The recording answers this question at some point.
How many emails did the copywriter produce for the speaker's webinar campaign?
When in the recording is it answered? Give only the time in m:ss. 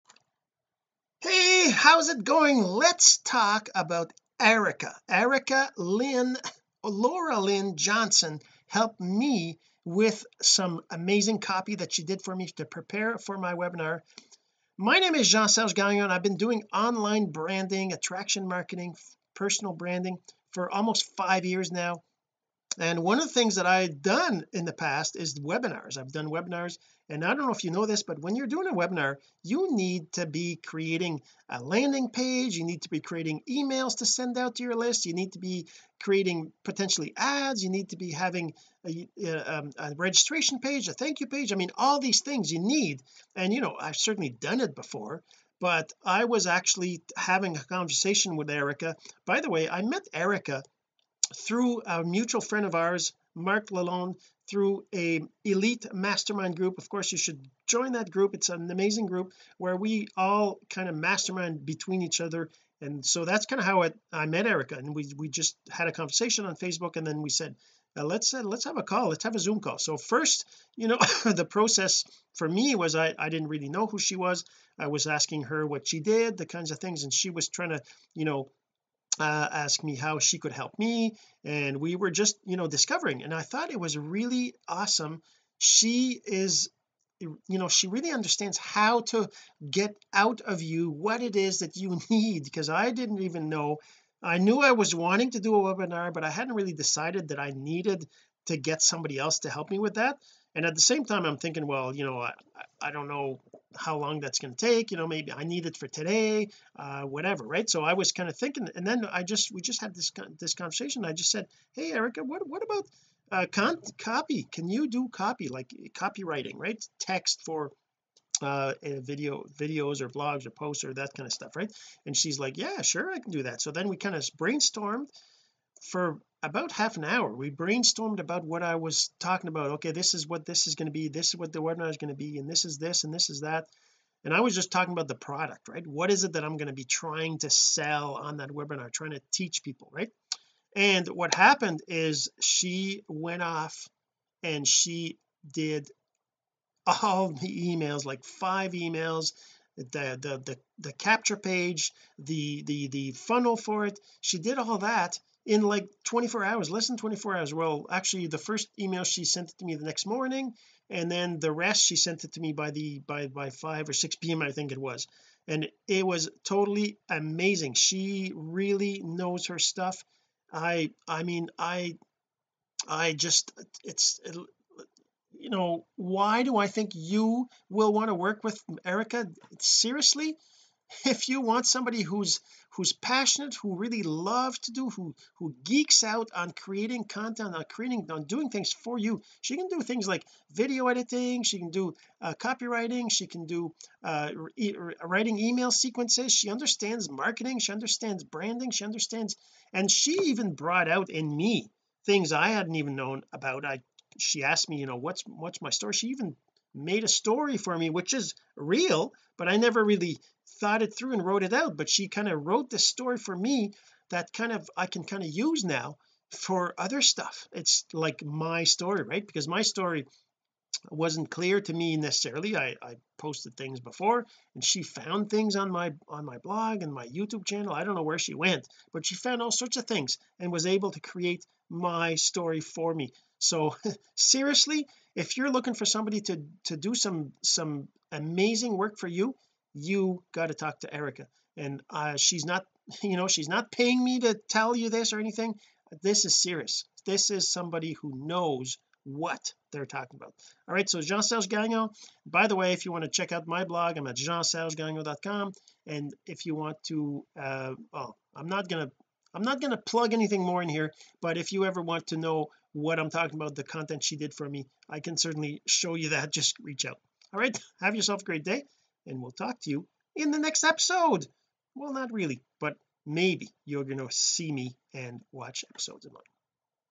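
2:28.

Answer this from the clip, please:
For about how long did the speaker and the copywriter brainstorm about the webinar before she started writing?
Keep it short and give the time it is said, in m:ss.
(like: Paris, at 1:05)
half an hour, at 2:06.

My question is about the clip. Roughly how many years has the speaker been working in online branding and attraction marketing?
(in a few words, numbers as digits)
5.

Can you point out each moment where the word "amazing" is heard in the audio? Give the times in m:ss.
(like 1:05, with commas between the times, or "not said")
0:10, 0:58, 2:47, 3:58.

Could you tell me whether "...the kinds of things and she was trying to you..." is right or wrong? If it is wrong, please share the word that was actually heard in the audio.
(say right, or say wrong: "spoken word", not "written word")
right.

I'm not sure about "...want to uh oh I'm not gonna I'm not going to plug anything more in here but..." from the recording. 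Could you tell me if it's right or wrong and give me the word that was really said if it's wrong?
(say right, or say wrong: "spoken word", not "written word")
right.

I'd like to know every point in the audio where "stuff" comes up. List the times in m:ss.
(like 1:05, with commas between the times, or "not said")
2:01, 2:49, 3:37.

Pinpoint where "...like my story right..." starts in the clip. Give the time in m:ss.
3:37.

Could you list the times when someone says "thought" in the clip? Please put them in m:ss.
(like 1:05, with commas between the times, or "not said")
1:23, 3:30.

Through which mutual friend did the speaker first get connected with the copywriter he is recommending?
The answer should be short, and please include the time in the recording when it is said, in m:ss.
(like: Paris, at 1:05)
Mark Lalonde, at 0:53.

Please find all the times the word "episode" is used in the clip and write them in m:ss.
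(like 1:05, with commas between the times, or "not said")
4:30, 4:35.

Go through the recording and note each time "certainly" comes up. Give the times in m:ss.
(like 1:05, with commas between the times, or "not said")
0:43, 4:25.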